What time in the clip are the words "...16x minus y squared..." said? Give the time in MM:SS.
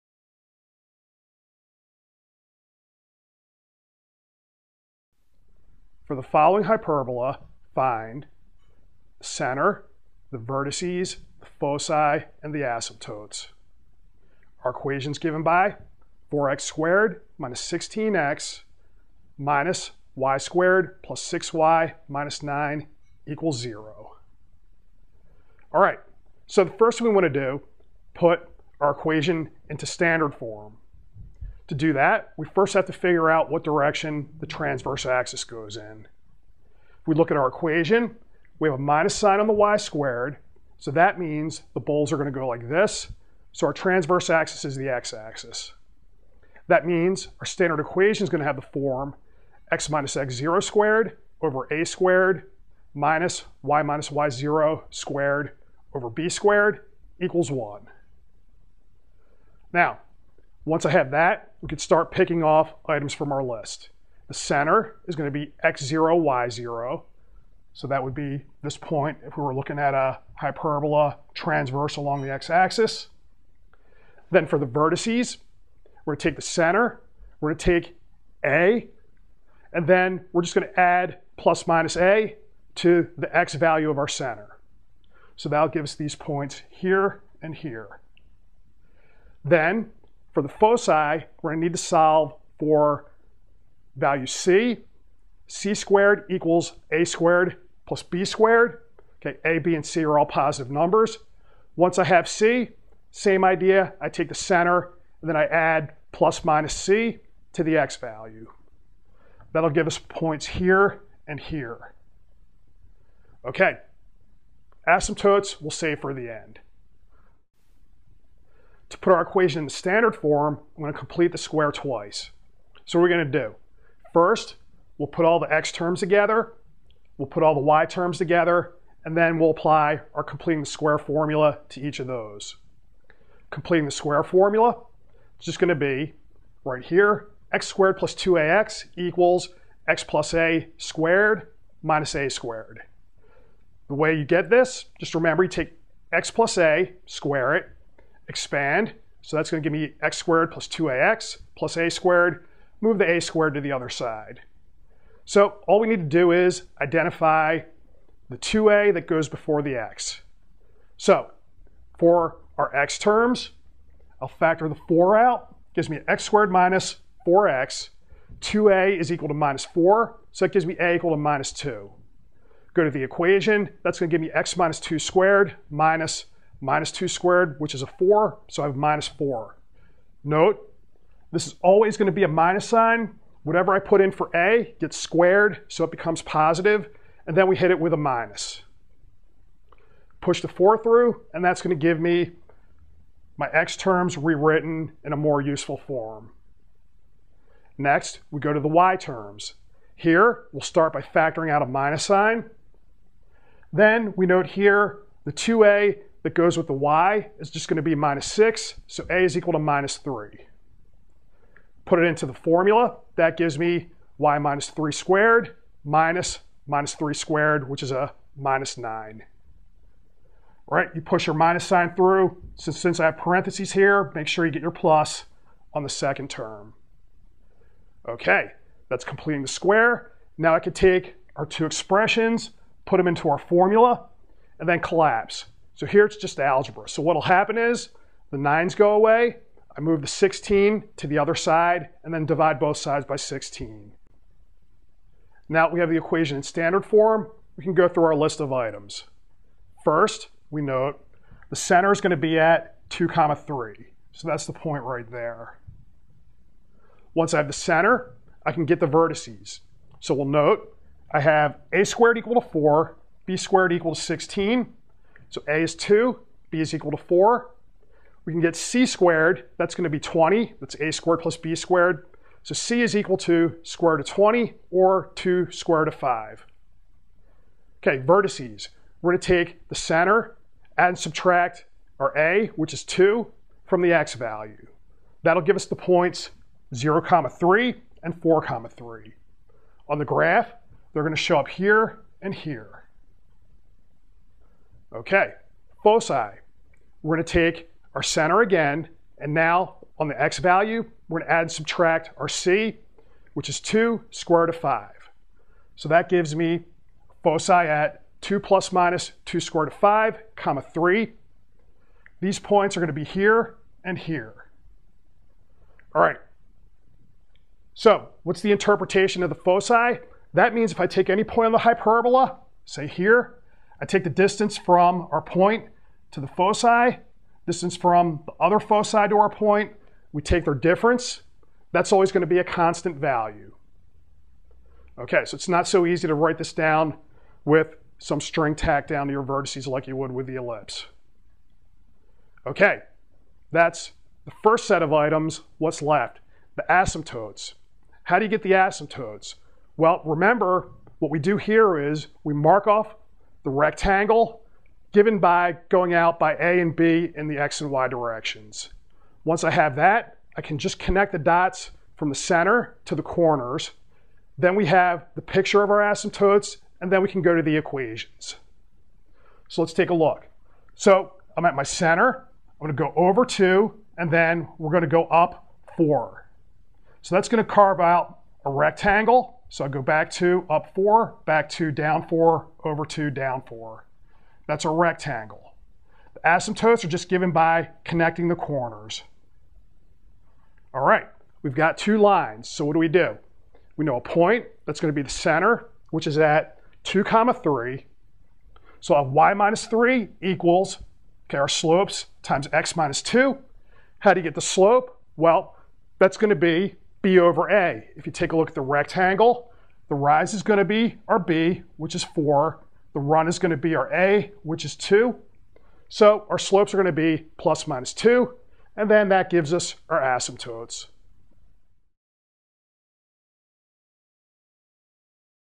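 00:17.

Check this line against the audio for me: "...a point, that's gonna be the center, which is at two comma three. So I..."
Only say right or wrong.
right.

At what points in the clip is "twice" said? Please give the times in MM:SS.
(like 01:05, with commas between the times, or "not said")
02:01.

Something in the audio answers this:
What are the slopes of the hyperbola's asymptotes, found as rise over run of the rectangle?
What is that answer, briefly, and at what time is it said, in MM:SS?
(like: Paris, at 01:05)
plus or minus 2, at 06:57.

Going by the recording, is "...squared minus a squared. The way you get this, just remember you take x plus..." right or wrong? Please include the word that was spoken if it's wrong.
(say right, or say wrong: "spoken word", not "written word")
right.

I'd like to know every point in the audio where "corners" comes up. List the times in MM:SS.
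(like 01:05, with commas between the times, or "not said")
06:03, 06:28.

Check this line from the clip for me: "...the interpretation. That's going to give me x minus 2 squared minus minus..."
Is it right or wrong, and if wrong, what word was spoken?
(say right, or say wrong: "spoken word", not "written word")
wrong: "equation", not "interpretation".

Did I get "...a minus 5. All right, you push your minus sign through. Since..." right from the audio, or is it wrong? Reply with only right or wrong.
wrong.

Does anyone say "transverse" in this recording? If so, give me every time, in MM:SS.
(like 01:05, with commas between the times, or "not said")
00:34, 00:43, 01:11.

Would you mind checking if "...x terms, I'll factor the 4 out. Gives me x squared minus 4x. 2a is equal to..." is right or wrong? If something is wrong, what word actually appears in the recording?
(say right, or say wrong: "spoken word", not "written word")
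right.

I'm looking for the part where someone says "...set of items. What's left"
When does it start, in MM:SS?
05:44.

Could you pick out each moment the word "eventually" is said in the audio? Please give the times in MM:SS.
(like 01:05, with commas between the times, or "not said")
not said.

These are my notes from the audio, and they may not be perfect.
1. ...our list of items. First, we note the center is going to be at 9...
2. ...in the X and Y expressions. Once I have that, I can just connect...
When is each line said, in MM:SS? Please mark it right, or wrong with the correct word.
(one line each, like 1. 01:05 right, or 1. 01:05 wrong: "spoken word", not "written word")
1. 04:08 wrong: "2", not "9"
2. 05:57 wrong: "directions", not "expressions".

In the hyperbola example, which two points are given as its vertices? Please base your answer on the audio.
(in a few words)
(0, 3) and (4, 3).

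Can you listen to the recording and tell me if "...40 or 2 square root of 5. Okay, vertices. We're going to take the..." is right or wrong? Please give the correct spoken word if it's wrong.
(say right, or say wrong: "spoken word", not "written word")
wrong: "20", not "40".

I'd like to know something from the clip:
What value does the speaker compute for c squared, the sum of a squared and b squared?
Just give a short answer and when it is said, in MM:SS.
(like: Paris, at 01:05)
20, at 04:29.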